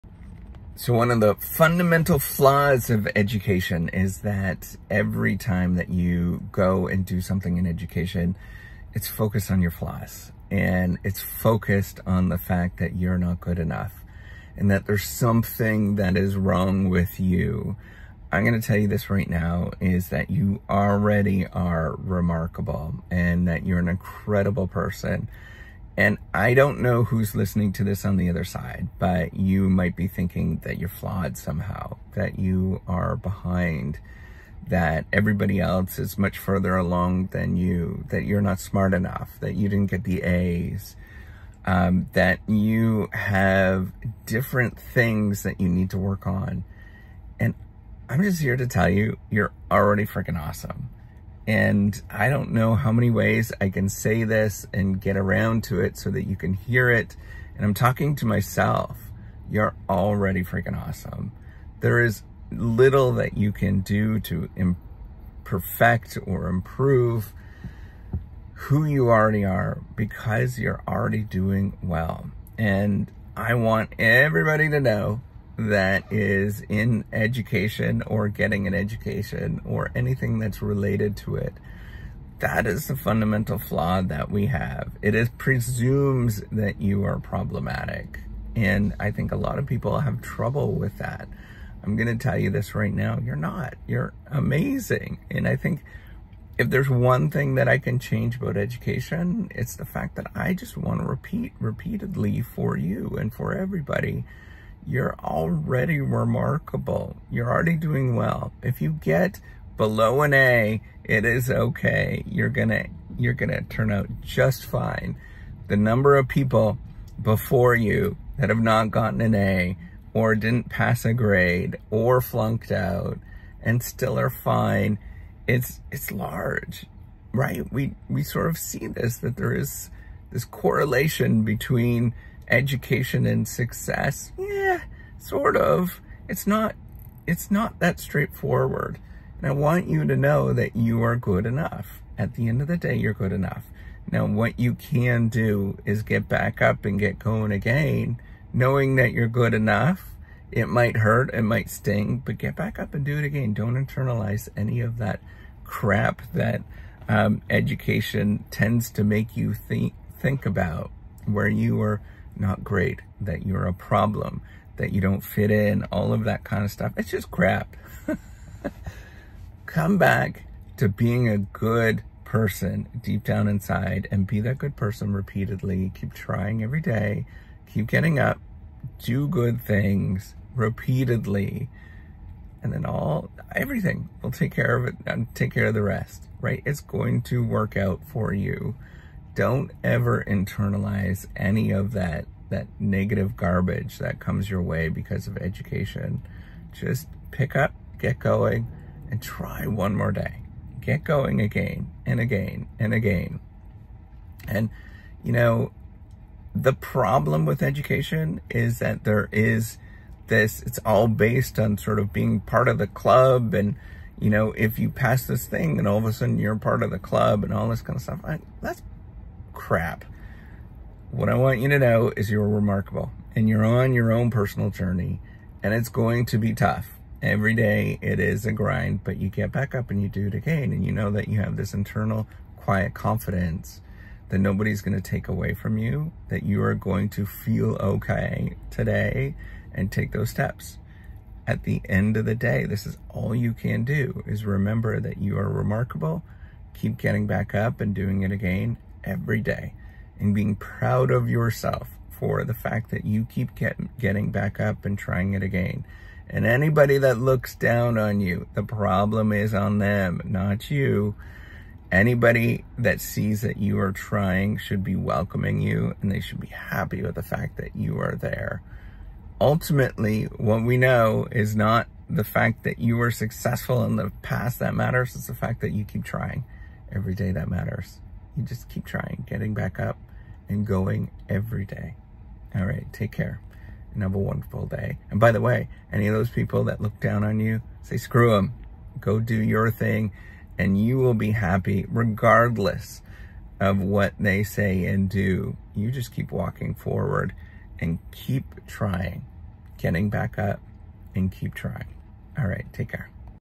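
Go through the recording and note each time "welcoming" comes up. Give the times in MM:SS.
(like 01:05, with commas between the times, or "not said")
04:24.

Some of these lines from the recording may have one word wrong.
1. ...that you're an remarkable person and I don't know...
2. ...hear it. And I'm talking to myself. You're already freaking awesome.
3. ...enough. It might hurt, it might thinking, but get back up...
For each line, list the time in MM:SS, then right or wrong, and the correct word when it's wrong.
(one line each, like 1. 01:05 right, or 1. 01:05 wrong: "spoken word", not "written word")
1. 00:23 wrong: "incredible", not "remarkable"
2. 00:56 right
3. 02:29 wrong: "sting", not "thinking".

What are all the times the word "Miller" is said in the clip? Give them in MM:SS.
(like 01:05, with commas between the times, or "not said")
not said.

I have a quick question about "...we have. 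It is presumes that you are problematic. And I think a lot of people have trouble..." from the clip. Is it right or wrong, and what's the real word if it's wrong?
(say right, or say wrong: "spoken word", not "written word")
right.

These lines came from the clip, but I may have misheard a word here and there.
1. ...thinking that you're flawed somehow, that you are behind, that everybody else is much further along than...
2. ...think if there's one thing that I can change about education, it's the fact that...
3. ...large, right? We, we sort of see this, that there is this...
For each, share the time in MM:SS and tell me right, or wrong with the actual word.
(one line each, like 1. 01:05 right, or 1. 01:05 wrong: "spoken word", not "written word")
1. 00:30 right
2. 01:35 right
3. 02:06 right.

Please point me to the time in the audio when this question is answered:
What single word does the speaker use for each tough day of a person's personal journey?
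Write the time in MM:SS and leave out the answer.
03:48.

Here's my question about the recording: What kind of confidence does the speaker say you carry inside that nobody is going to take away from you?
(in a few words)
internal quiet confidence.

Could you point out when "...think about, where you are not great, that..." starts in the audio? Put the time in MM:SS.
02:40.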